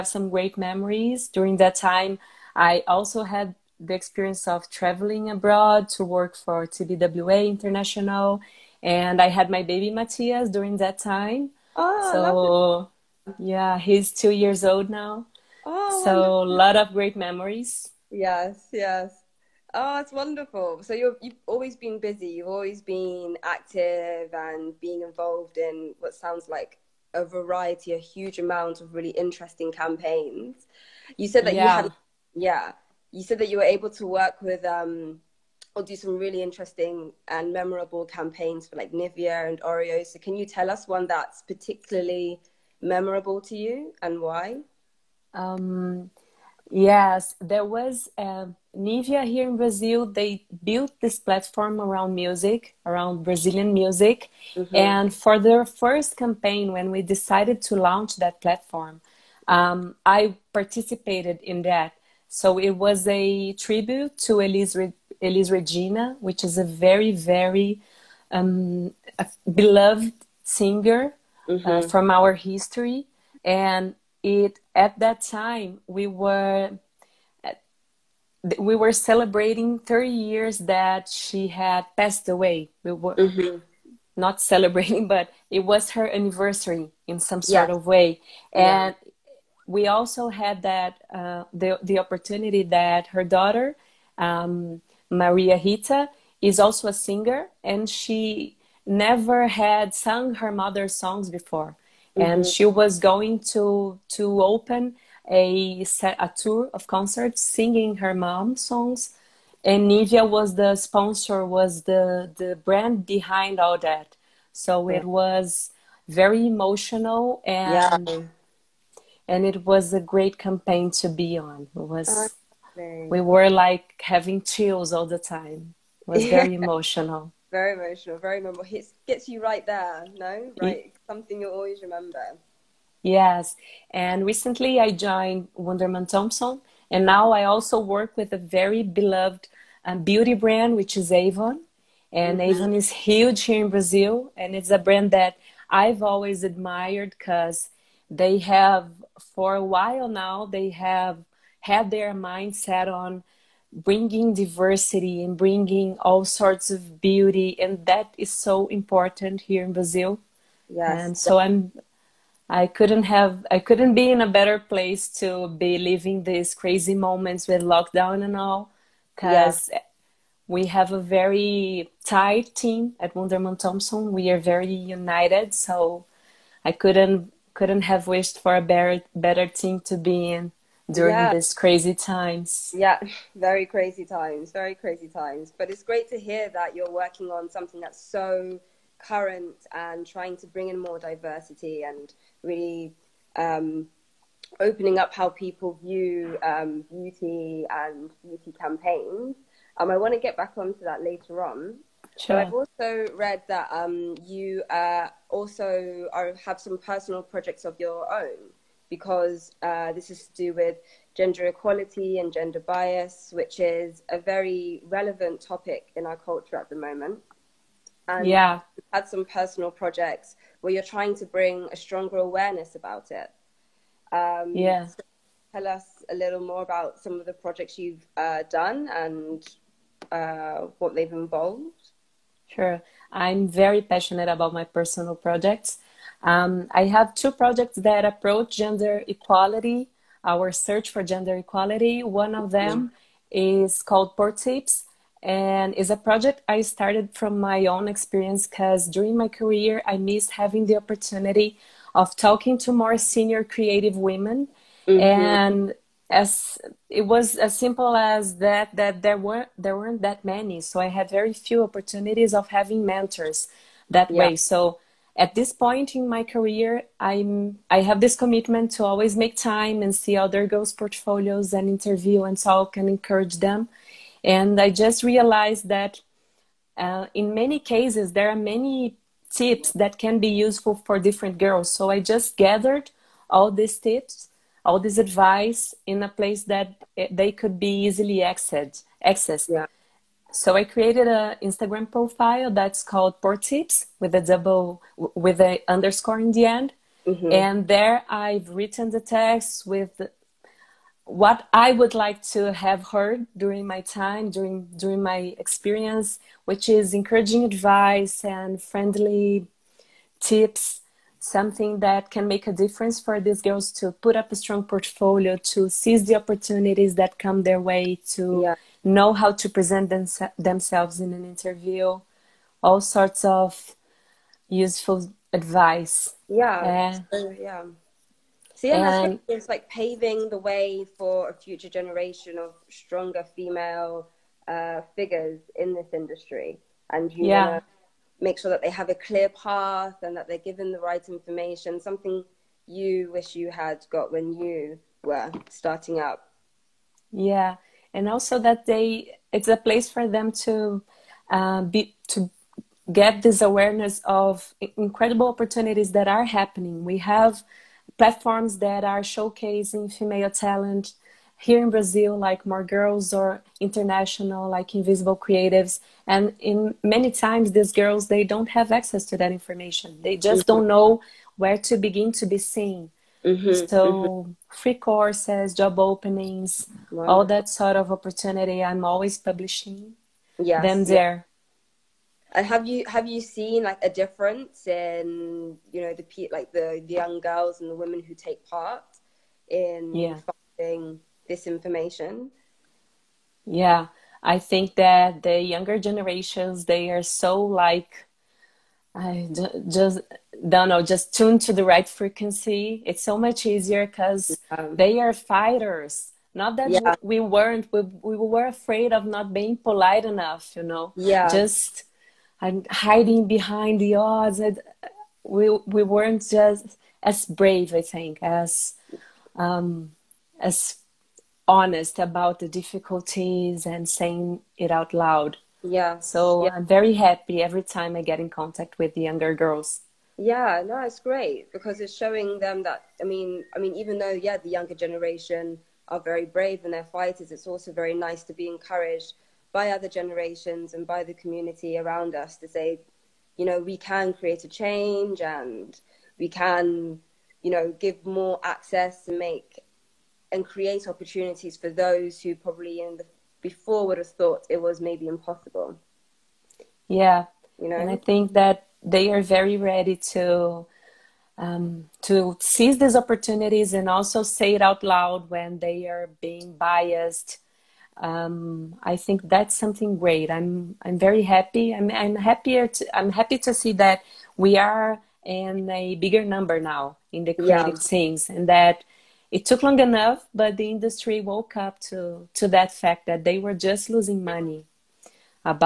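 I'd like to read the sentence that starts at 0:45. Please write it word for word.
Um, Yes, there was uh, Nivea here in Brazil.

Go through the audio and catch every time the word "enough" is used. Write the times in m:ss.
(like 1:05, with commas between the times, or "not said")
6:50, 7:59.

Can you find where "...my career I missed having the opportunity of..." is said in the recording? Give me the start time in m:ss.
4:09.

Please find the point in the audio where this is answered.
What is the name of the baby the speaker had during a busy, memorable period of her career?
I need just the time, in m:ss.
0:09.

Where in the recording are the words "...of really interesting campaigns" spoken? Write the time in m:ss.
0:28.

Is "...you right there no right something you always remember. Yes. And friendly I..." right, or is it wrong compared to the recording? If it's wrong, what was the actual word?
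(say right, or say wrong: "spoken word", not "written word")
wrong: "recently", not "friendly".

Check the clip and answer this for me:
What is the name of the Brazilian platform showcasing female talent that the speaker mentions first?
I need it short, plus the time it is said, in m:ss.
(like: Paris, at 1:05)
More Girls, at 6:02.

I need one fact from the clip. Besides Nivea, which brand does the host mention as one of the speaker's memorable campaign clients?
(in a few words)
Oreo.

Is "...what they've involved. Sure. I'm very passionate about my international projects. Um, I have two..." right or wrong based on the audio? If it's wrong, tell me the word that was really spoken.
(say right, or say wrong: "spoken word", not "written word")
wrong: "personal", not "international".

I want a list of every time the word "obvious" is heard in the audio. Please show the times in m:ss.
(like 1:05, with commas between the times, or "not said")
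not said.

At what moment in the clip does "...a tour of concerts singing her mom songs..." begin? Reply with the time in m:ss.
1:46.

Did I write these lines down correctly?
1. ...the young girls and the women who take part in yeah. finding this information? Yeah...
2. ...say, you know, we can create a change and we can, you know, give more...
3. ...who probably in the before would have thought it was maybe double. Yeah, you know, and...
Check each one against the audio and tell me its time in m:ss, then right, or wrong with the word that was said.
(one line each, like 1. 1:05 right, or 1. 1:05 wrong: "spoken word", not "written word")
1. 6:26 right
2. 7:22 right
3. 7:32 wrong: "impossible", not "double".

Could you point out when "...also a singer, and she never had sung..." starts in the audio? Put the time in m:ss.
1:36.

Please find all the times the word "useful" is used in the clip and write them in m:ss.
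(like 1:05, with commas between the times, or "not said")
4:40, 5:24.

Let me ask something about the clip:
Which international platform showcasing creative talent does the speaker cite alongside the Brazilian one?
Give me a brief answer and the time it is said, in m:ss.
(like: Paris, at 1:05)
Invisible Creatives, at 6:04.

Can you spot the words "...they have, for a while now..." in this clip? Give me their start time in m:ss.
2:28.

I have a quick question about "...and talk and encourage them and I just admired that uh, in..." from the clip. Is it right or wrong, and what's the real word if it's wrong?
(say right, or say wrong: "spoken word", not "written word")
wrong: "realized", not "admired".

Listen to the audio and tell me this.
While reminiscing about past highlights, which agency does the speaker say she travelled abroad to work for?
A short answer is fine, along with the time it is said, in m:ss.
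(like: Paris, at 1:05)
TBWA International, at 0:06.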